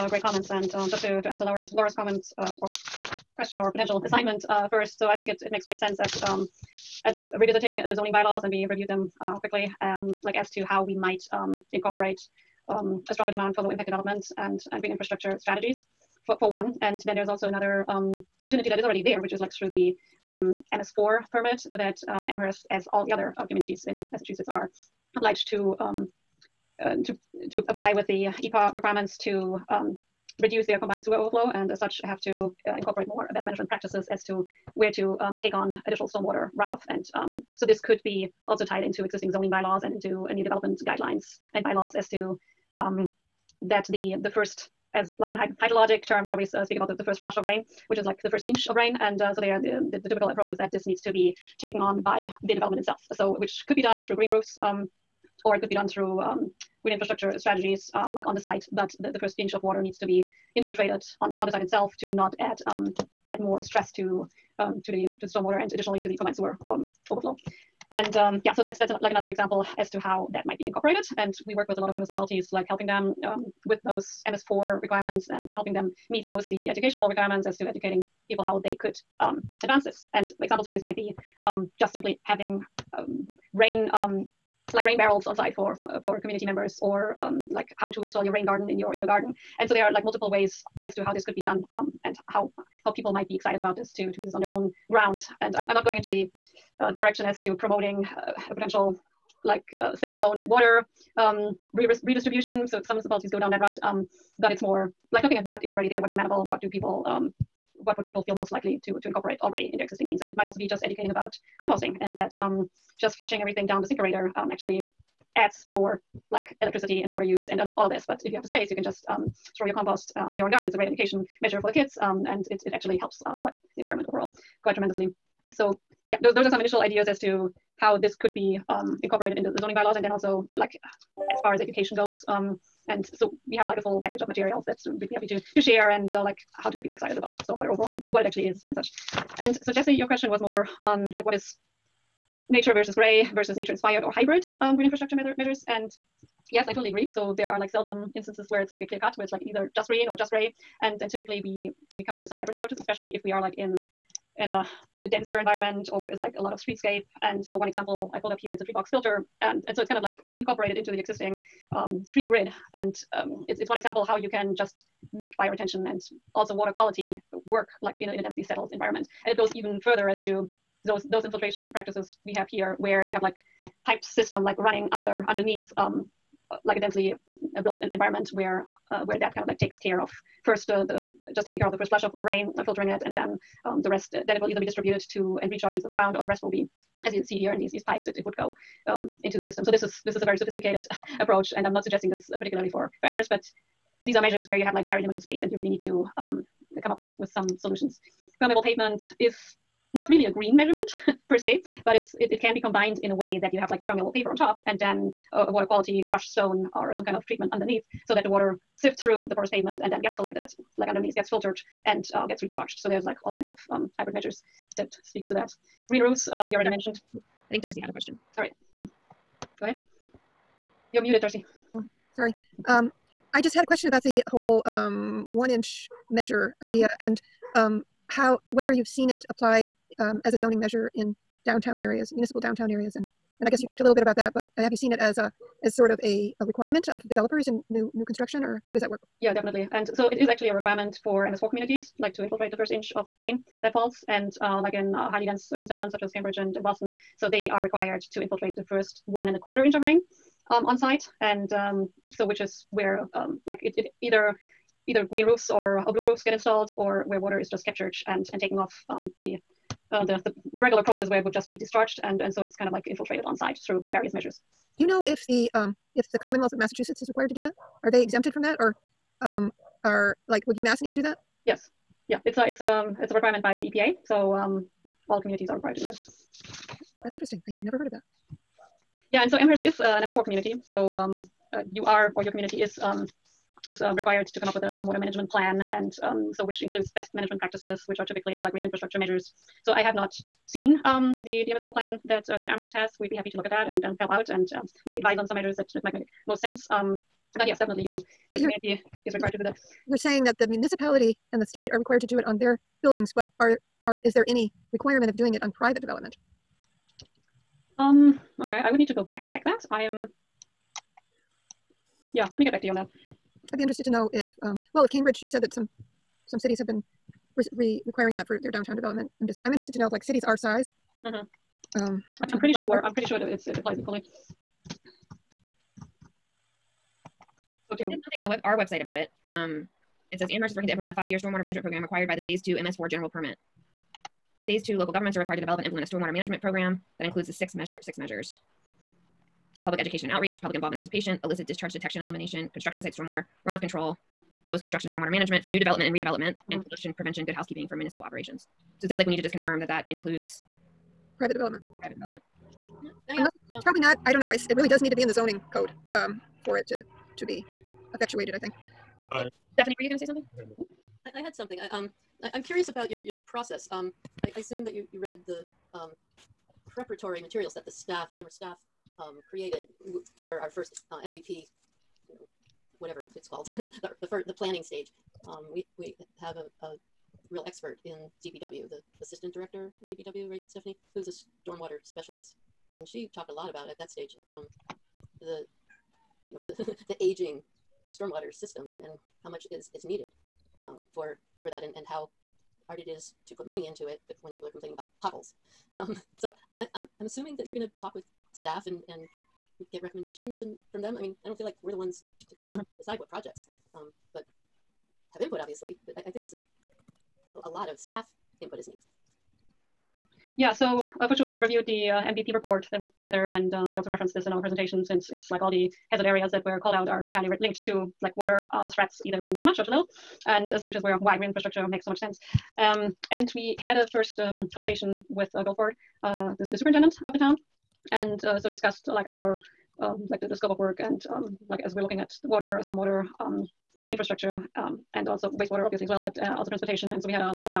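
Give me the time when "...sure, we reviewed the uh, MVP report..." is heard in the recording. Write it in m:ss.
6:51.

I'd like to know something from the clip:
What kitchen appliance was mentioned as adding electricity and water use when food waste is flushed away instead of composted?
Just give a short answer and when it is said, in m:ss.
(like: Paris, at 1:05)
InSinkErator, at 1:53.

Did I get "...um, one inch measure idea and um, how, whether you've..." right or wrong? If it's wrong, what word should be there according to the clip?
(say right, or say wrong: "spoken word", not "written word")
right.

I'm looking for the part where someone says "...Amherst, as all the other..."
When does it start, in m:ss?
0:22.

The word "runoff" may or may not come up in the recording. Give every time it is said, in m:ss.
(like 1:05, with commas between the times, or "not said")
0:36, 5:43.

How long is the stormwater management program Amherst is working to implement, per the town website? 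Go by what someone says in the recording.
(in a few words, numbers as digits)
5 years.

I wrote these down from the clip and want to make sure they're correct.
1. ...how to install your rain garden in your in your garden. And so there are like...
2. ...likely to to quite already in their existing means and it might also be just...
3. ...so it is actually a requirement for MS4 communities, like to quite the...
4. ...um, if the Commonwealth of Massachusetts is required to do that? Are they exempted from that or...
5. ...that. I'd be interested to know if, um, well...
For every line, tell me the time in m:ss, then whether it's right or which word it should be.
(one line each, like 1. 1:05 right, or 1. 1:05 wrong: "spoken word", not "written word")
1. 1:27 right
2. 1:48 wrong: "incorporate", not "quite"
3. 3:59 wrong: "infiltrate", not "quite"
4. 4:25 right
5. 5:12 right.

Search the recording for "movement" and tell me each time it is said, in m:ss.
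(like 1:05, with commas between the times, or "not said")
not said.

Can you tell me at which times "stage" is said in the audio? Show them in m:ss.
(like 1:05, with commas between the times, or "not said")
6:14, 6:23.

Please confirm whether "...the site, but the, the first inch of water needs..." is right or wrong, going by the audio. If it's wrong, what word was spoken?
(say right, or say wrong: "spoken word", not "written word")
right.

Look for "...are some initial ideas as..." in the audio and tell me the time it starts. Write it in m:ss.
2:06.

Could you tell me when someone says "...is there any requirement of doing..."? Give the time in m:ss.
5:04.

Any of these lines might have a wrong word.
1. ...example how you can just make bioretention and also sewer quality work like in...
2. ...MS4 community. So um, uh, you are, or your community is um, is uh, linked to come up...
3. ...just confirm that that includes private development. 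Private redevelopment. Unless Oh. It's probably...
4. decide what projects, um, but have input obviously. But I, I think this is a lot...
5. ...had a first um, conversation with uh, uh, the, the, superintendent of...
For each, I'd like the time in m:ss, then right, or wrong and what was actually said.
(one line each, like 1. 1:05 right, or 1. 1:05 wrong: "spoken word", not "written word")
1. 2:43 wrong: "water", not "sewer"
2. 4:40 wrong: "required", not "linked"
3. 5:49 wrong: "development", not "redevelopment"
4. 6:42 right
5. 7:03 right.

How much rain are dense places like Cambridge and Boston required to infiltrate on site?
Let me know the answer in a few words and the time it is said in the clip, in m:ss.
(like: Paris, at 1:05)
1 and a quarter inch, at 4:09.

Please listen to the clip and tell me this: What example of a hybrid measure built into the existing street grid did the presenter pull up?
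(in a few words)
tree box filter.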